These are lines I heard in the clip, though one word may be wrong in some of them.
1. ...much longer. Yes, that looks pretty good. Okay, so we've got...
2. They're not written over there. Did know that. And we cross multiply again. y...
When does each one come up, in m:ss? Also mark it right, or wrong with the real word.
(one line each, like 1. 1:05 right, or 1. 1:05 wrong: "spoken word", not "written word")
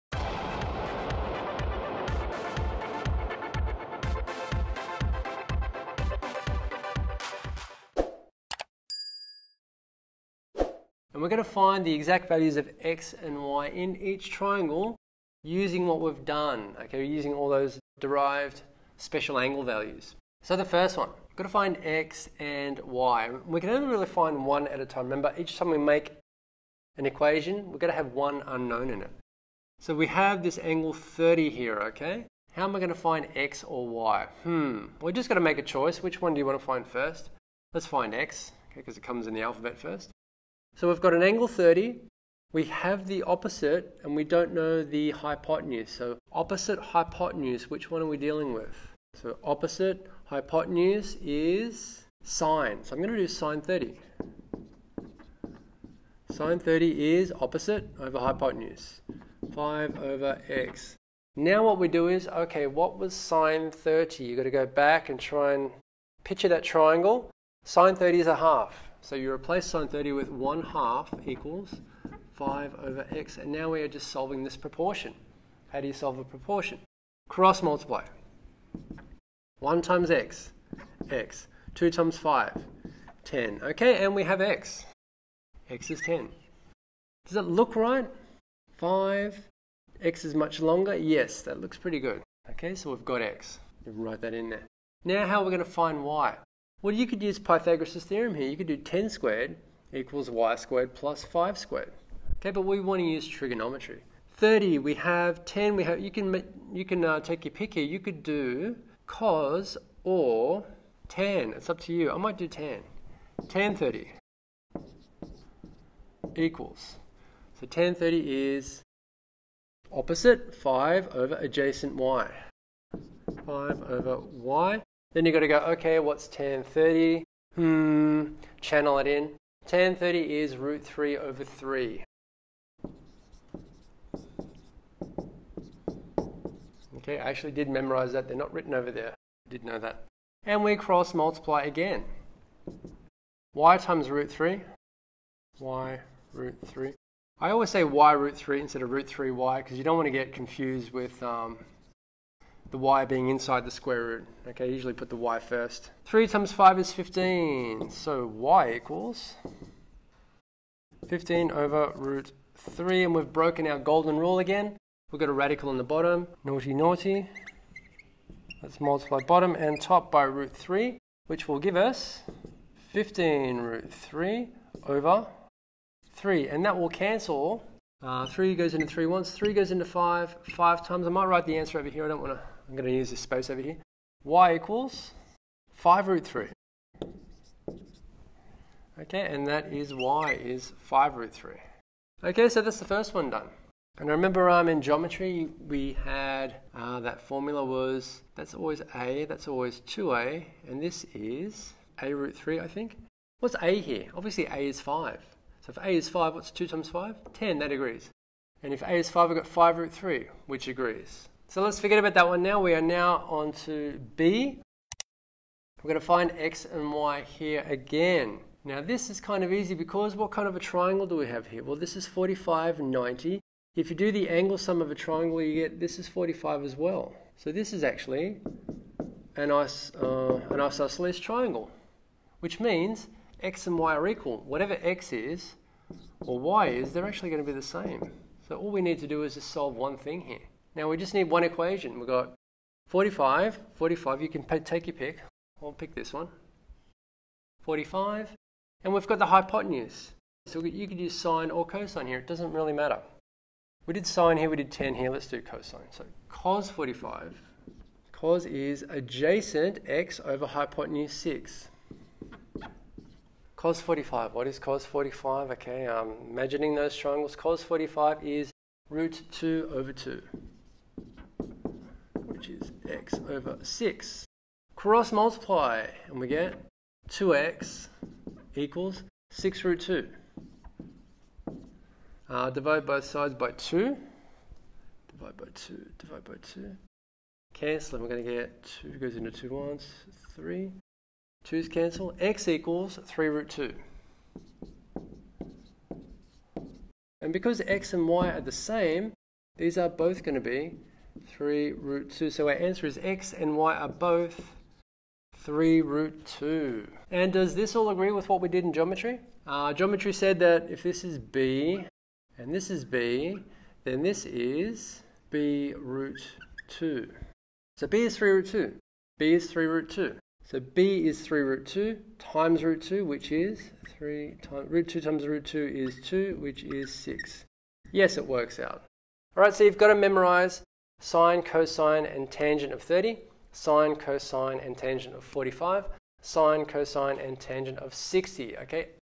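1. 1:30 right
2. 2:18 right.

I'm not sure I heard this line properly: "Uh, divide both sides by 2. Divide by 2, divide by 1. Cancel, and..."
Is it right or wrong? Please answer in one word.
wrong.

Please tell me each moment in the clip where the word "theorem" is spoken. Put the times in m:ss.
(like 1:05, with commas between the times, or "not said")
1:38.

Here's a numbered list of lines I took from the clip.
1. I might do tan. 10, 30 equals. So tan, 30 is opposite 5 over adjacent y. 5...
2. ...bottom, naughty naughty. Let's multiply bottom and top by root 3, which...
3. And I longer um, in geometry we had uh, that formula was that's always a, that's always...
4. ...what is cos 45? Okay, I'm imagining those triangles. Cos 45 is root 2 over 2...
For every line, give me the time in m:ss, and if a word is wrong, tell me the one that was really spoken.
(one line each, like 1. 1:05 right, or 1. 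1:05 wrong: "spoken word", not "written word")
1. 1:52 right
2. 2:45 right
3. 3:13 wrong: "remember", not "longer"
4. 4:24 right.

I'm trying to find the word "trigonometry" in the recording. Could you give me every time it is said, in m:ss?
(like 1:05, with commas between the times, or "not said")
1:43.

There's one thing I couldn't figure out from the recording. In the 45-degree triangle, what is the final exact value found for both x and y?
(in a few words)
3 root 2.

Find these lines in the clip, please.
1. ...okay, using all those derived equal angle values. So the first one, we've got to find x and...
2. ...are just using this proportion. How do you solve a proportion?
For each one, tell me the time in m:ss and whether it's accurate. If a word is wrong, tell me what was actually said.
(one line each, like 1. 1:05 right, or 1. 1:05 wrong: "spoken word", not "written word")
1. 0:16 wrong: "special", not "equal"
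2. 1:13 wrong: "solving", not "using".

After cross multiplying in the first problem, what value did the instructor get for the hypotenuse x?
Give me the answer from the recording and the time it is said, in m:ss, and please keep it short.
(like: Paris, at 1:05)
10, at 1:25.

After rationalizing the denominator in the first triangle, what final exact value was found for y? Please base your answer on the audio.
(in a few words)
5 root 3.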